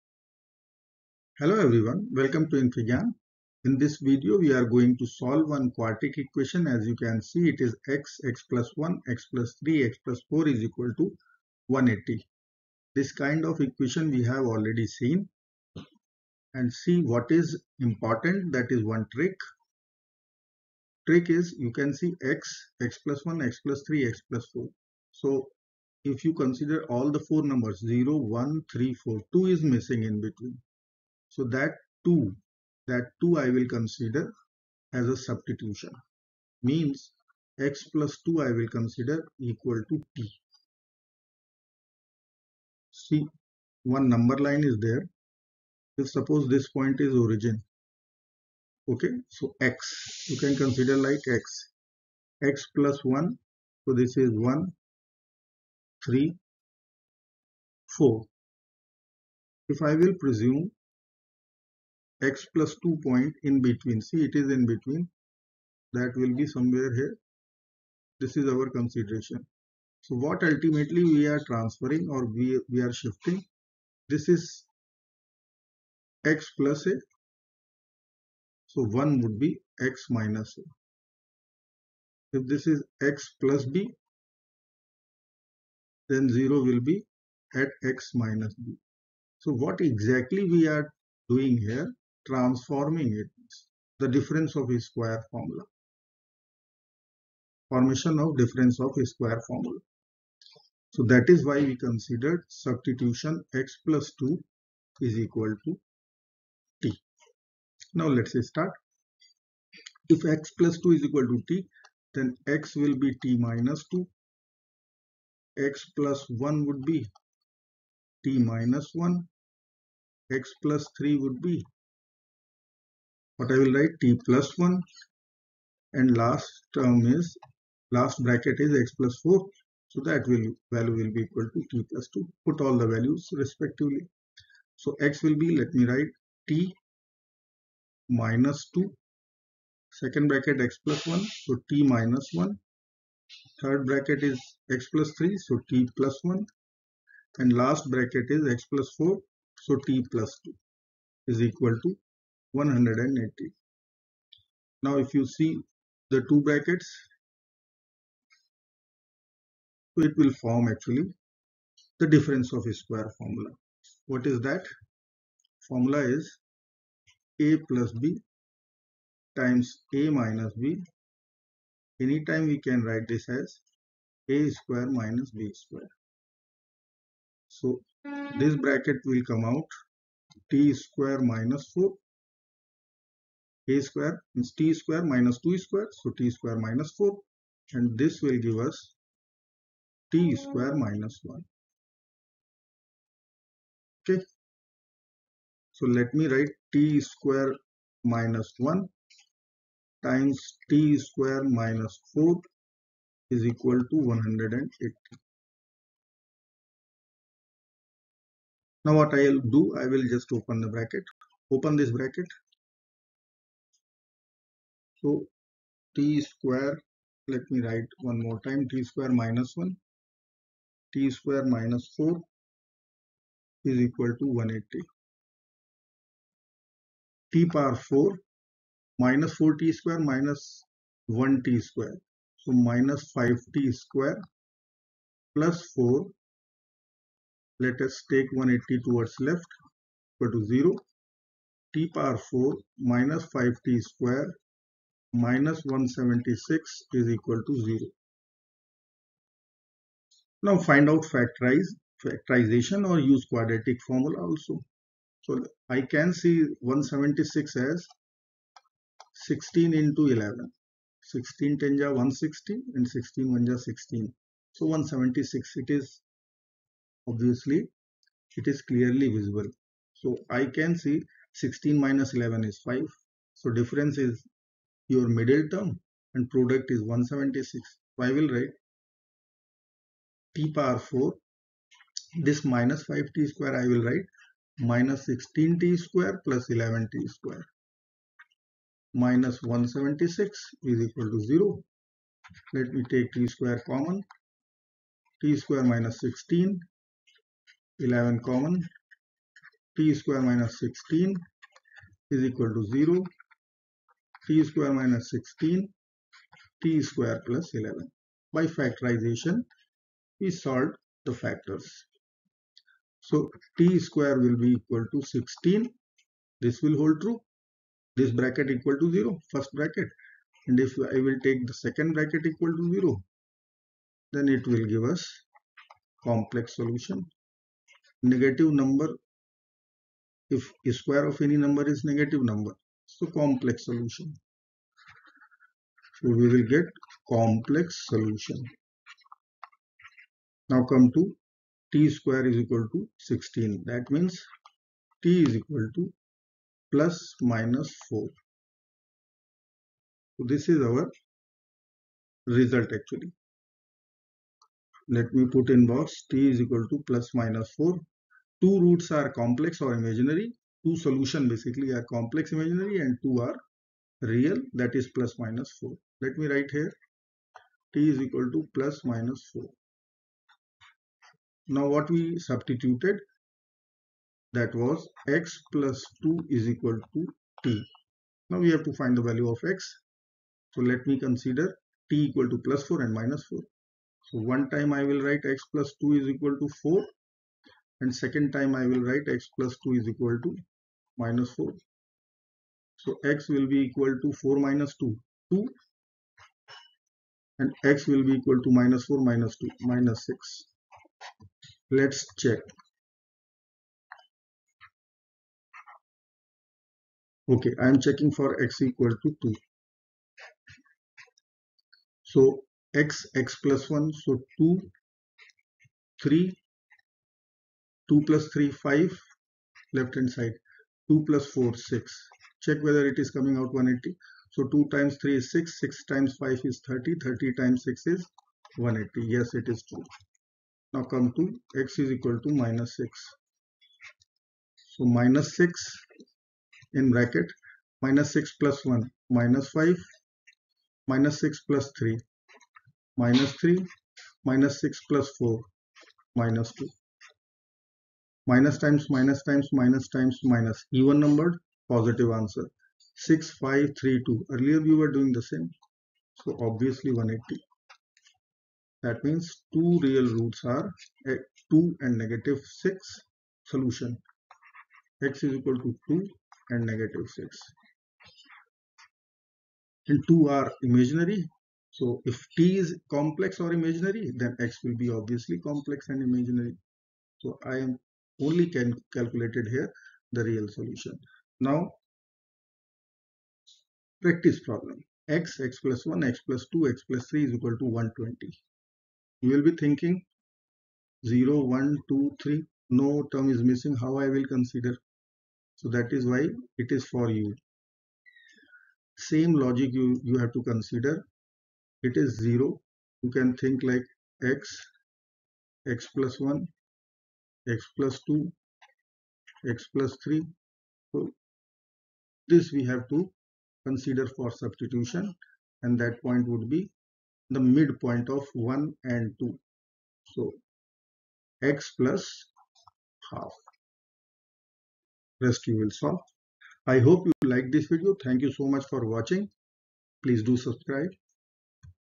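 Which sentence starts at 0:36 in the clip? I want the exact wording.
Means x plus 2 I will consider equal to t.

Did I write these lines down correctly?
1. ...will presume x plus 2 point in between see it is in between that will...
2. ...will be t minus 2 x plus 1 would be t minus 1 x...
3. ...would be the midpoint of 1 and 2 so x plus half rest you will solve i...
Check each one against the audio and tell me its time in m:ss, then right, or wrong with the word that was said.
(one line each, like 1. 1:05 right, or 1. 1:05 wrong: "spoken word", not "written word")
1. 0:59 right
2. 1:52 right
3. 8:36 right.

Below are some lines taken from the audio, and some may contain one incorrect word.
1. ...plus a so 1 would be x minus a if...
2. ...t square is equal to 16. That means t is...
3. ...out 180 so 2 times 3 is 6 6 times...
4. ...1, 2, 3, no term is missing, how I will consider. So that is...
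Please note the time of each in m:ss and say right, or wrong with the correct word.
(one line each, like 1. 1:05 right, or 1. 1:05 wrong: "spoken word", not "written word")
1. 1:16 right
2. 5:41 right
3. 7:03 right
4. 8:11 right.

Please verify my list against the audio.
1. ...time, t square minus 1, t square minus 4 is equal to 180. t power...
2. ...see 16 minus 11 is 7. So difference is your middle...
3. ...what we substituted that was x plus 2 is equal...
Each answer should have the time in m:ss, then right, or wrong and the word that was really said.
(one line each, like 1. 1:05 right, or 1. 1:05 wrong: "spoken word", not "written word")
1. 3:38 right
2. 4:30 wrong: "5", not "7"
3. 6:11 right.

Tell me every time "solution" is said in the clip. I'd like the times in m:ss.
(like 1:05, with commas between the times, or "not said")
5:26, 5:33, 5:37, 6:00, 7:43, 8:00.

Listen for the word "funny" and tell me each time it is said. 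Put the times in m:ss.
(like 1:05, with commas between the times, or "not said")
not said.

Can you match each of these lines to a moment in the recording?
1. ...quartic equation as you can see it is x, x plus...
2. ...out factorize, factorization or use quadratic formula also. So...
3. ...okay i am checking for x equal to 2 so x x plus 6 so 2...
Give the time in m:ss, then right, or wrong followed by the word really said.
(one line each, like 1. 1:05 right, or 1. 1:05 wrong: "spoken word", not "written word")
1. 0:05 right
2. 4:10 right
3. 6:47 wrong: "1", not "6".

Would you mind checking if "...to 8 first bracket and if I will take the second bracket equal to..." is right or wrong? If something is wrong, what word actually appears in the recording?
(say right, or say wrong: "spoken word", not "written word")
wrong: "0", not "8".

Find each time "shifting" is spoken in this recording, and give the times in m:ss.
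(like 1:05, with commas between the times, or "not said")
1:12.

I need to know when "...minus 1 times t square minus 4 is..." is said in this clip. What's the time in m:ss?
3:18.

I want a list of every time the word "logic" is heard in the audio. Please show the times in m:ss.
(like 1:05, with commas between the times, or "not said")
8:19.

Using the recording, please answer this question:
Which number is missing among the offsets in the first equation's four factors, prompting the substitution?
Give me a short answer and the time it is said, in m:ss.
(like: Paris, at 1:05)
2, at 0:29.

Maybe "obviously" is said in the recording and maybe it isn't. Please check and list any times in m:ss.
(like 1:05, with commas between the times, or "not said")
4:27, 7:36, 7:55.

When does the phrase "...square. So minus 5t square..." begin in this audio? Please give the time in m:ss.
3:51.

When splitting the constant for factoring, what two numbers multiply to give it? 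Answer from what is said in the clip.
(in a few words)
16 and 11.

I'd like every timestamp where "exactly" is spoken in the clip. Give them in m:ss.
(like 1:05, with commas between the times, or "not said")
1:29.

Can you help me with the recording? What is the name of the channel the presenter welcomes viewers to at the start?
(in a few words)
infyGyan.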